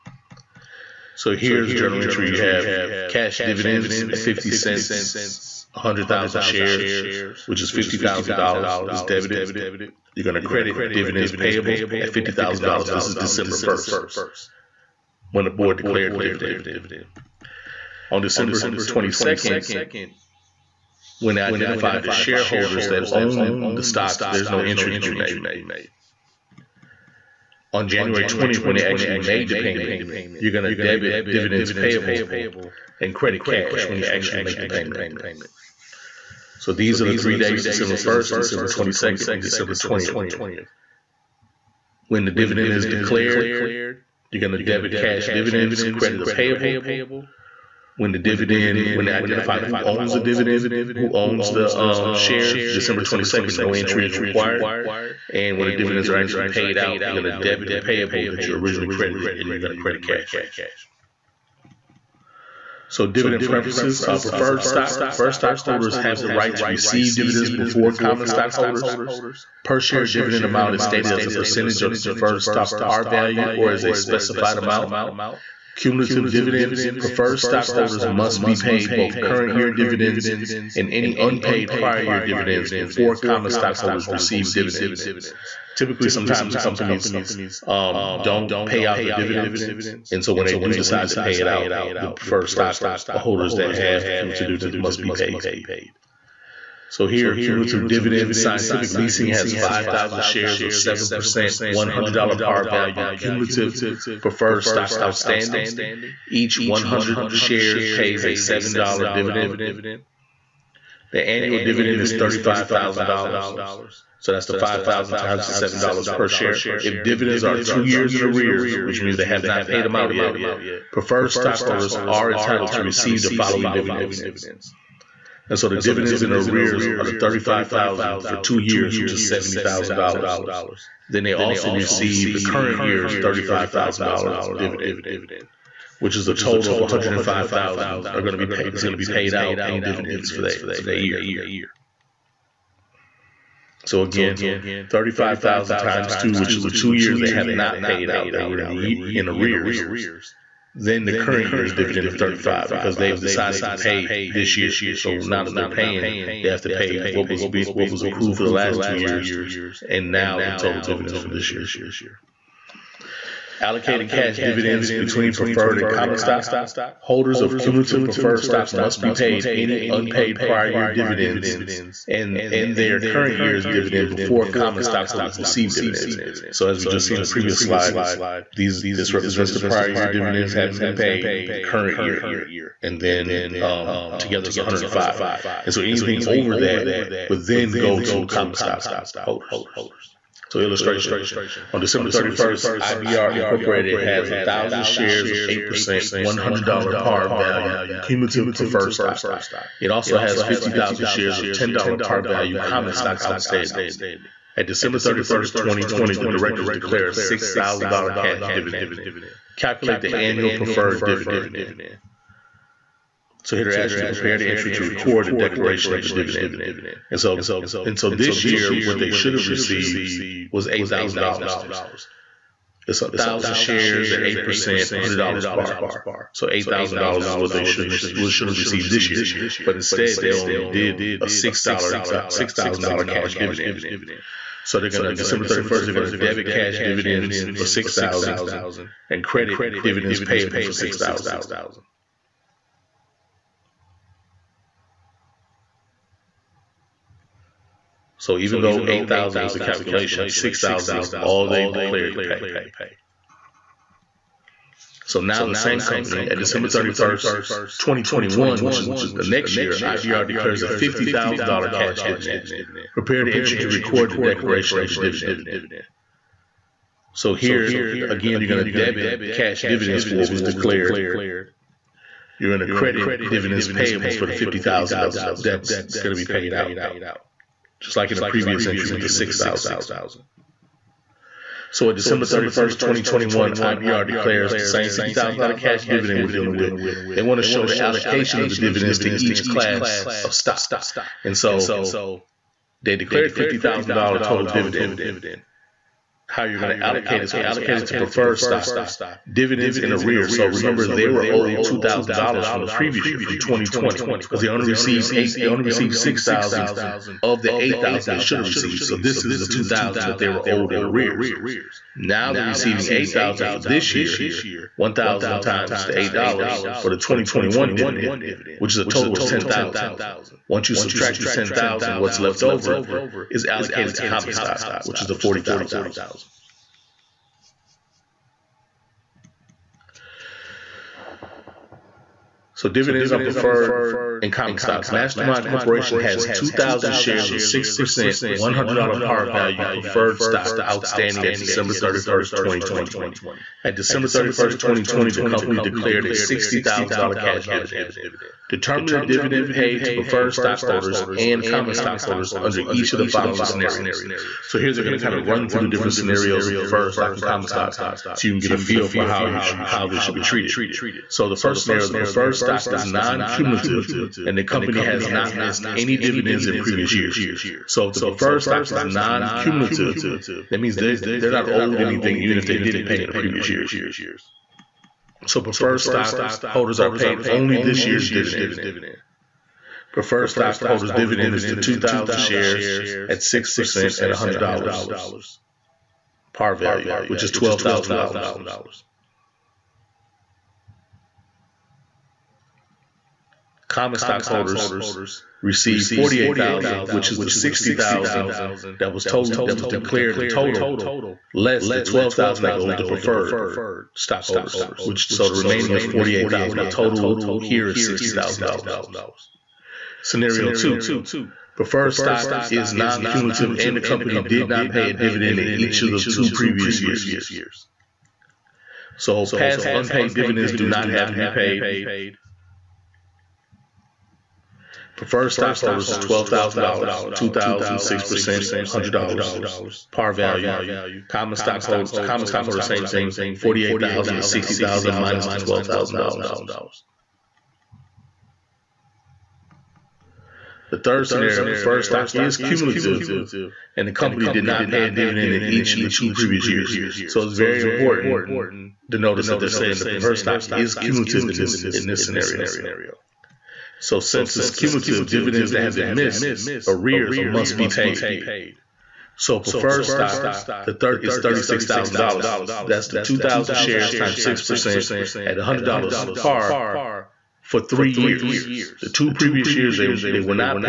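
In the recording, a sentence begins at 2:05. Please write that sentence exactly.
And so the dividends in arrears are the thirty-five thousand for two years, which is seventy thousand dollars.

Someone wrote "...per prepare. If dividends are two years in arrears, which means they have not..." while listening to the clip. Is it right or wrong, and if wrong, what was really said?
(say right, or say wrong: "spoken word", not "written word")
wrong: "share", not "prepare".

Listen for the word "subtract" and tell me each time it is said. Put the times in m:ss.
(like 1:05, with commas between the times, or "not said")
5:20.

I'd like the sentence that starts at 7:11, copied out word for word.
Common stockholders, common stockholders, same thing, forty-eight thousand to sixty thousand minus the twelve thousand dollars.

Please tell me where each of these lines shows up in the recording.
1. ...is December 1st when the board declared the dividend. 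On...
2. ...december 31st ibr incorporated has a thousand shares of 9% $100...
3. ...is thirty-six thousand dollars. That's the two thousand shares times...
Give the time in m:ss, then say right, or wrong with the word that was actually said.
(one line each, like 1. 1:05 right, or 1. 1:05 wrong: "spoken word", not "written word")
1. 0:13 right
2. 3:11 wrong: "8", not "9"
3. 7:41 right.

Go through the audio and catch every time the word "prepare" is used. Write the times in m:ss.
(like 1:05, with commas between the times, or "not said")
3:34, 4:22.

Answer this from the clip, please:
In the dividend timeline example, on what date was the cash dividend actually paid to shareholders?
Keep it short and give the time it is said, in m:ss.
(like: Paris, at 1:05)
January 20th, at 0:27.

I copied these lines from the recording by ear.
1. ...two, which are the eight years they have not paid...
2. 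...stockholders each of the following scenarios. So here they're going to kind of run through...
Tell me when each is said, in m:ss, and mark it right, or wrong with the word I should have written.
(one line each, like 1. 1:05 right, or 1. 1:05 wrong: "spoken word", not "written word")
1. 2:26 wrong: "two", not "eight"
2. 5:52 wrong: "under", not "stockholders".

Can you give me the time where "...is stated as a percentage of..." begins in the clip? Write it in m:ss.
1:10.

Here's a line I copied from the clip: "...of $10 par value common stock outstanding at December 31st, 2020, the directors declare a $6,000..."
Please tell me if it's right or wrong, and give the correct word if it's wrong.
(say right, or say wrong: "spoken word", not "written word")
right.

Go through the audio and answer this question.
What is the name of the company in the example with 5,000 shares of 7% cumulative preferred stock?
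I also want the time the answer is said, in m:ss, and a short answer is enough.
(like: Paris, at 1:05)
Scientific Leasing, at 1:38.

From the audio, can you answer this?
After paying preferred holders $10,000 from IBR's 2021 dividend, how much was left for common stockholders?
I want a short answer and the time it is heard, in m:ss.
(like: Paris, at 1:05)
$40,000, at 5:25.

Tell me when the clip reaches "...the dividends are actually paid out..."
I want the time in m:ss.
0:55.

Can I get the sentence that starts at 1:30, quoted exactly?
And so when they do decide to pay it out, the preferred stockholders that have cumulative dividends must be paid.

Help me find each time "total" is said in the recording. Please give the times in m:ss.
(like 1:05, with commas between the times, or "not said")
2:16, 2:40, 4:54, 5:18, 6:40, 6:46.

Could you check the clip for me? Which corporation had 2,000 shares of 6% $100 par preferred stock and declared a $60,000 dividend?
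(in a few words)
Mastermind Corporation.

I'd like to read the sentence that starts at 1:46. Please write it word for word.
Each 100 shares pays a $7 dividend.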